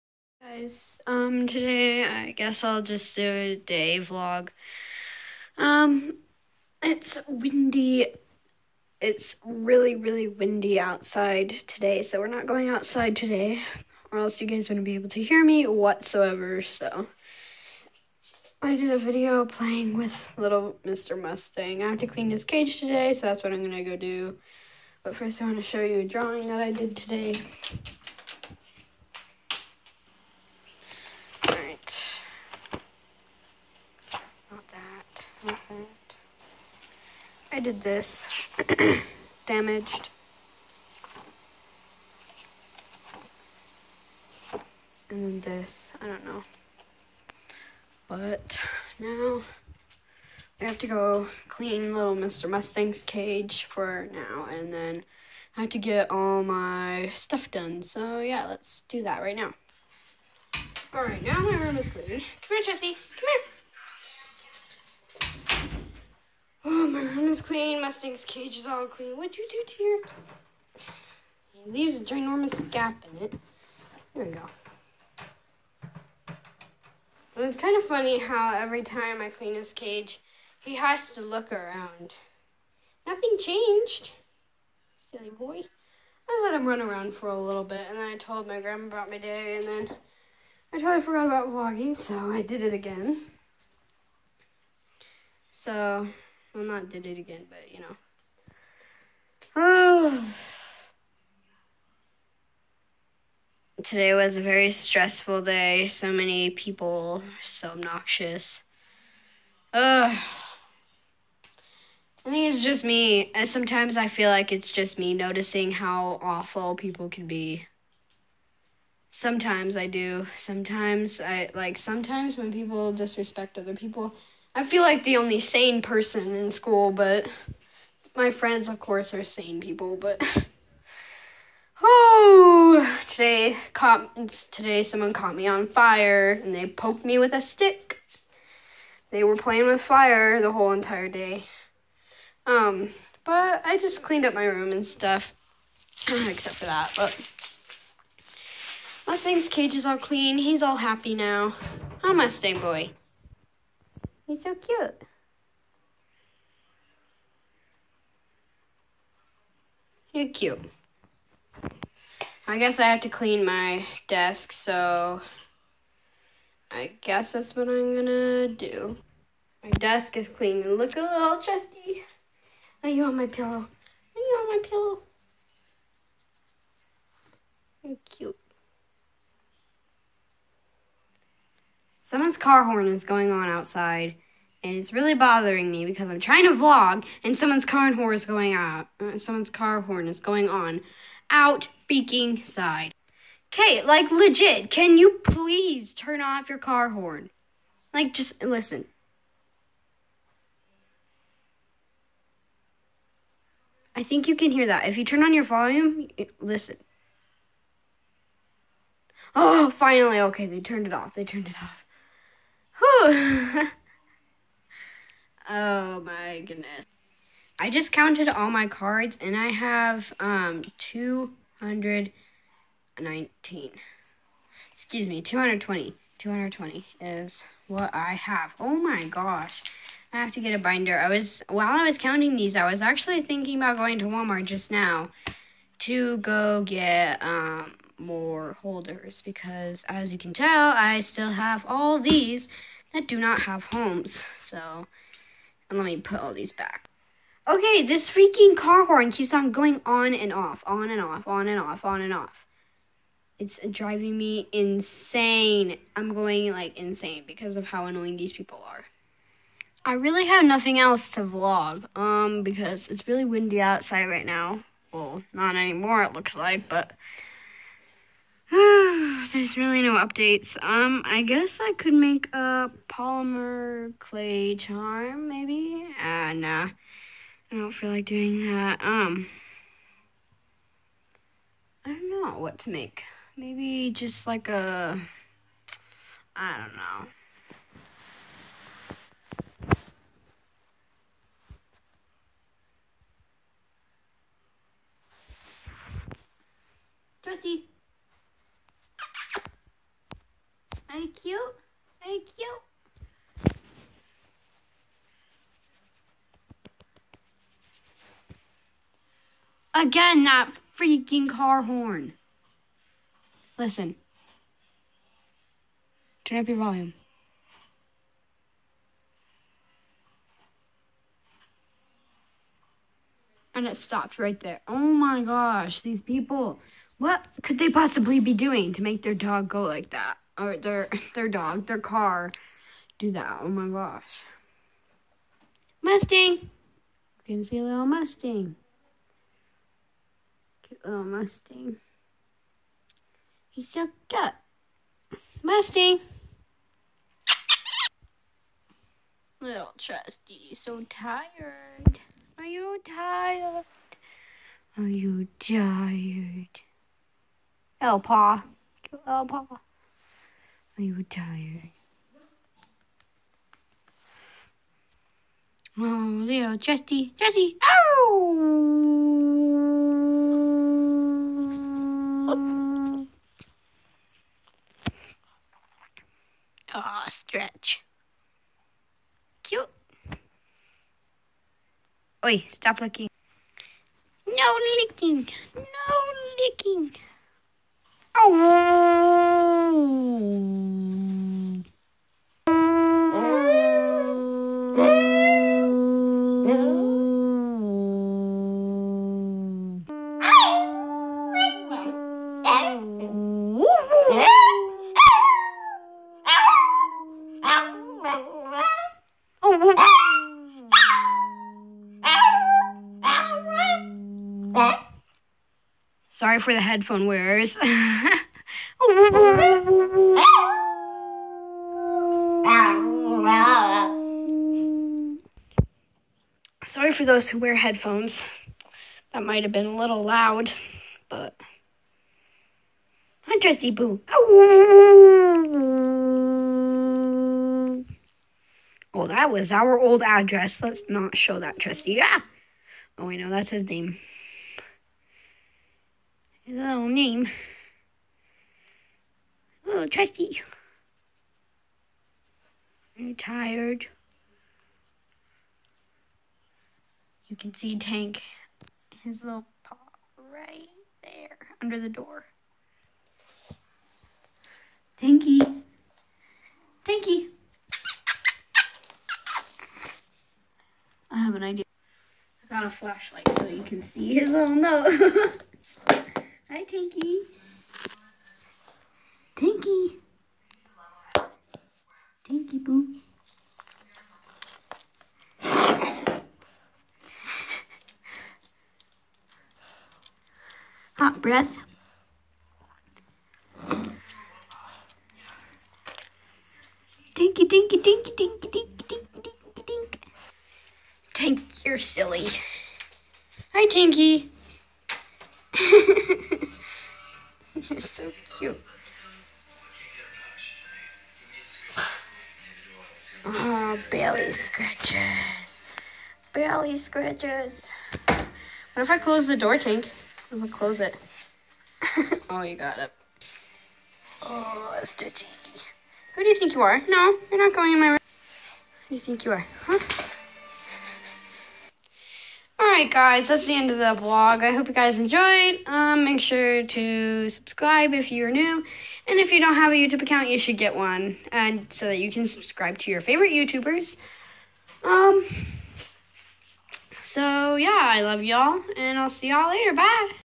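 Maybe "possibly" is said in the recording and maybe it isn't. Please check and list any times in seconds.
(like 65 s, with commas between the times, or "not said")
327 s.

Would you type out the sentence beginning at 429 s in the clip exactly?
That might have been a little loud, but I'm Trusty Boo.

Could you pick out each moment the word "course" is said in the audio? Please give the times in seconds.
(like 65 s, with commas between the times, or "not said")
128 s.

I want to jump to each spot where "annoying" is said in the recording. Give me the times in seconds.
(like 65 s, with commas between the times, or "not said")
257 s.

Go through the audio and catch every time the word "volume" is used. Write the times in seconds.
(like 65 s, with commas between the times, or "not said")
205 s, 316 s.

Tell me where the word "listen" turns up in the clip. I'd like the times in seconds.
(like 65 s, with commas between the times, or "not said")
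198 s, 206 s, 313 s.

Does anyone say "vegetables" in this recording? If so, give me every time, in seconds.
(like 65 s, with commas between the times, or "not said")
not said.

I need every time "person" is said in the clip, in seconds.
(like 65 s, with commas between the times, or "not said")
125 s.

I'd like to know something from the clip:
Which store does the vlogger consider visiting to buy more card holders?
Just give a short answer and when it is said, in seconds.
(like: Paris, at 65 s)
Walmart, at 234 s.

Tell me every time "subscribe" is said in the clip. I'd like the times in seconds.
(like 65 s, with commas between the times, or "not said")
537 s, 542 s.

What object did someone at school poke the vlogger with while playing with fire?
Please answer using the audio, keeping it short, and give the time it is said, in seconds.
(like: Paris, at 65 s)
A stick, at 137 s.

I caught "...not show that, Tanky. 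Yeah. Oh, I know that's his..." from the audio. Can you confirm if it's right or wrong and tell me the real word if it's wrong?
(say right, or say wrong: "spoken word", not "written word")
wrong: "Trusty", not "Tanky".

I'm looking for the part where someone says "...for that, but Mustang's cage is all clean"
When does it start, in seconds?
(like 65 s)
146 s.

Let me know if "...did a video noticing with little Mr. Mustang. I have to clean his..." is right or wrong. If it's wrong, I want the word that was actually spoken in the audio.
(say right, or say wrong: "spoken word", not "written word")
wrong: "playing", not "noticing".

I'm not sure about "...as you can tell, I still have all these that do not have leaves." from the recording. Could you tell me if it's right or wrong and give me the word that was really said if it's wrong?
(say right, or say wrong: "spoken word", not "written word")
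wrong: "homes", not "leaves".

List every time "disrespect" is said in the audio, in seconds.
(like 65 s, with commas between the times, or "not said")
122 s.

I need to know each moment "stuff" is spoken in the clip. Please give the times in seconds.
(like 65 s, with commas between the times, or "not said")
57 s, 144 s.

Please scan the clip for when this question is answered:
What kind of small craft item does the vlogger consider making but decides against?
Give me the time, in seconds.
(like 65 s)
272 s.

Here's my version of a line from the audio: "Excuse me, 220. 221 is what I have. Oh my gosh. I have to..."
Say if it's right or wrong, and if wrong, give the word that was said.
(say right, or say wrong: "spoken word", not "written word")
wrong: "220", not "221".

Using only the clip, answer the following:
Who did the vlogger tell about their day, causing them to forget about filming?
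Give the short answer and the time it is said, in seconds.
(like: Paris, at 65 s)
Grandma, at 88 s.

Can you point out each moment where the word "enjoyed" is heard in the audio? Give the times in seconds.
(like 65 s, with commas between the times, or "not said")
534 s.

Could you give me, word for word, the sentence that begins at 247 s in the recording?
Okay, this freaking car horn keeps on going on and off, on and off, on and off, on and off.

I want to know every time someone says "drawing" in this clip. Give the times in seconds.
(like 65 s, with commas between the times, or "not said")
26 s.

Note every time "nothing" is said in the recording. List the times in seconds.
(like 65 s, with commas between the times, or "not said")
83 s, 260 s.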